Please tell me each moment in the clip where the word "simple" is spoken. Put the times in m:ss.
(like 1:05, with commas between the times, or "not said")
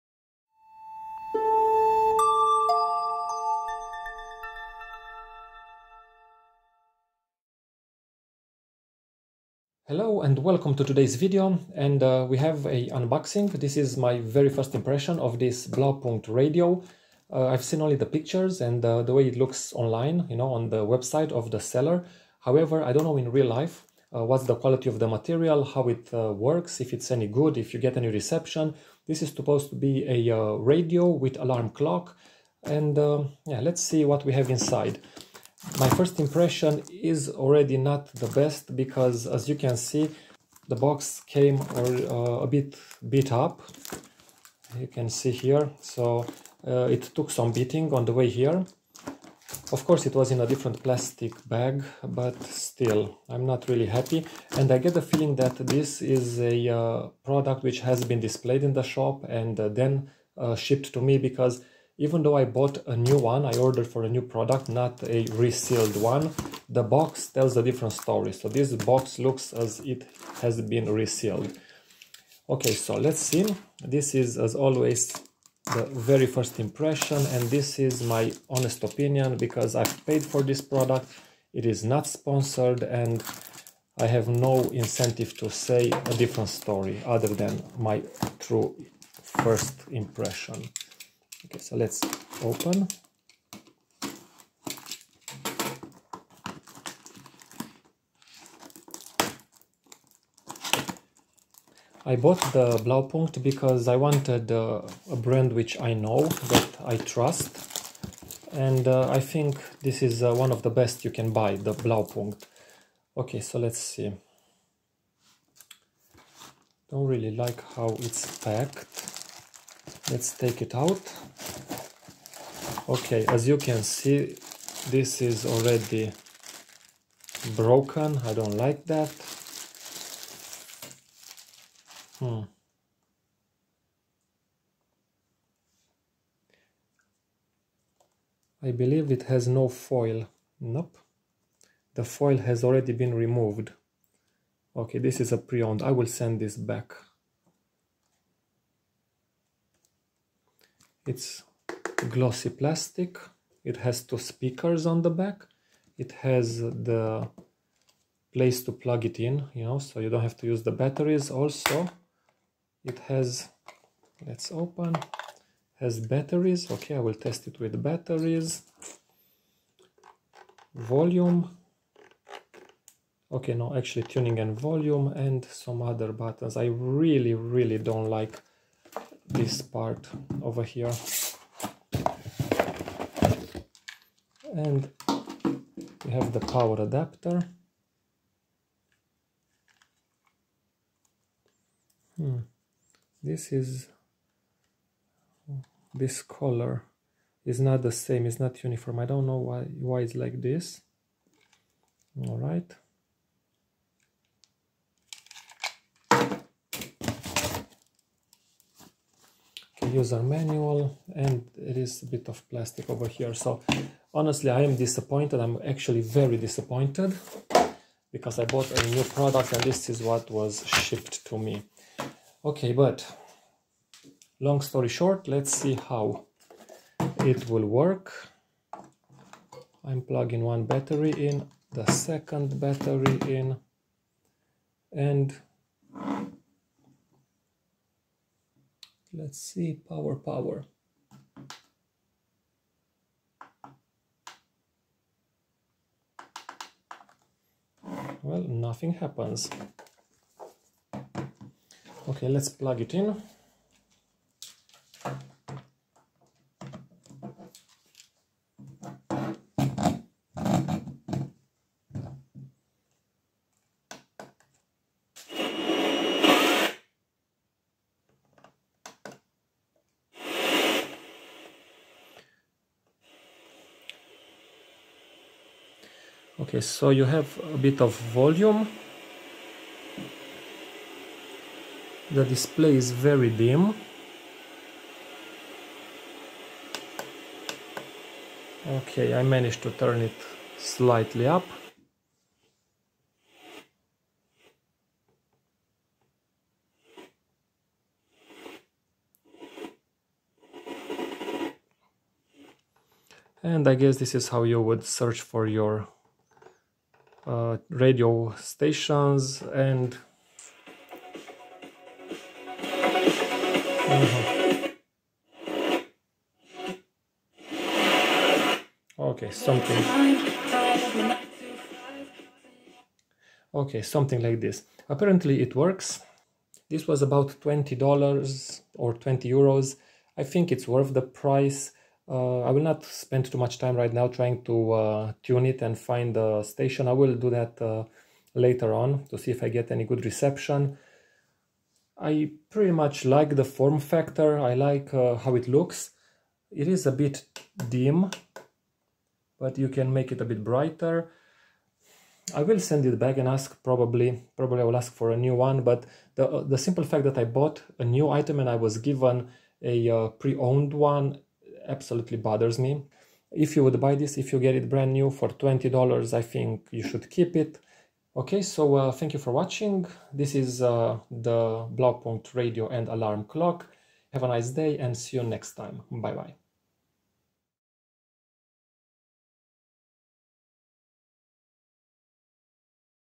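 5:56.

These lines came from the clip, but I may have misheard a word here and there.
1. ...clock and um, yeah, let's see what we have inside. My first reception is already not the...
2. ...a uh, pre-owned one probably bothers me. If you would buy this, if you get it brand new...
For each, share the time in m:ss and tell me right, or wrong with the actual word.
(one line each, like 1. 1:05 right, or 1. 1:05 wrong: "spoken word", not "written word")
1. 0:31 wrong: "impression", not "reception"
2. 5:59 wrong: "absolutely", not "probably".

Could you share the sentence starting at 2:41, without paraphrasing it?
Also, it has, let's open, has batteries.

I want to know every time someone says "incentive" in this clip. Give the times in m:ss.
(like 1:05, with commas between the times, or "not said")
1:24.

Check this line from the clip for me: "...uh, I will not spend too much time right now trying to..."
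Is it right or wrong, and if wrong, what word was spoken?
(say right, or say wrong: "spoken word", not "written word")
right.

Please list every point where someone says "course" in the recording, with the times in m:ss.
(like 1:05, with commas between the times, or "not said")
0:49.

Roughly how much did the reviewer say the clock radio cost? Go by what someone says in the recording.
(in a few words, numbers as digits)
20 dollars or 20 euros.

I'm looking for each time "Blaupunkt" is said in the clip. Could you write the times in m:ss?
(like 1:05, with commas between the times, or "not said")
0:15, 1:42, 1:51, 6:11.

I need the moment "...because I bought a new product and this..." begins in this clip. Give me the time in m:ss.
3:38.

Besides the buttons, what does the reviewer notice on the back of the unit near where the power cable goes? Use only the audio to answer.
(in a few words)
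two speakers.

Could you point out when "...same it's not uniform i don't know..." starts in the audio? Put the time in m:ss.
3:17.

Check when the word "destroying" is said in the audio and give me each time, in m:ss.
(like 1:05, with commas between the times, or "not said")
not said.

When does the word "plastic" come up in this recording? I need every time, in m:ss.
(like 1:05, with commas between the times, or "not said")
0:50, 2:32, 3:32.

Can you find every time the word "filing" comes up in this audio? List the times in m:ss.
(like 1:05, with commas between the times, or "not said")
not said.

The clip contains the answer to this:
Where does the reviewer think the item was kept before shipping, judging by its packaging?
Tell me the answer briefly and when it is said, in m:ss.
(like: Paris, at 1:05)
displayed in the shop, at 0:58.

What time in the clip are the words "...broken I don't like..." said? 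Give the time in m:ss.
2:07.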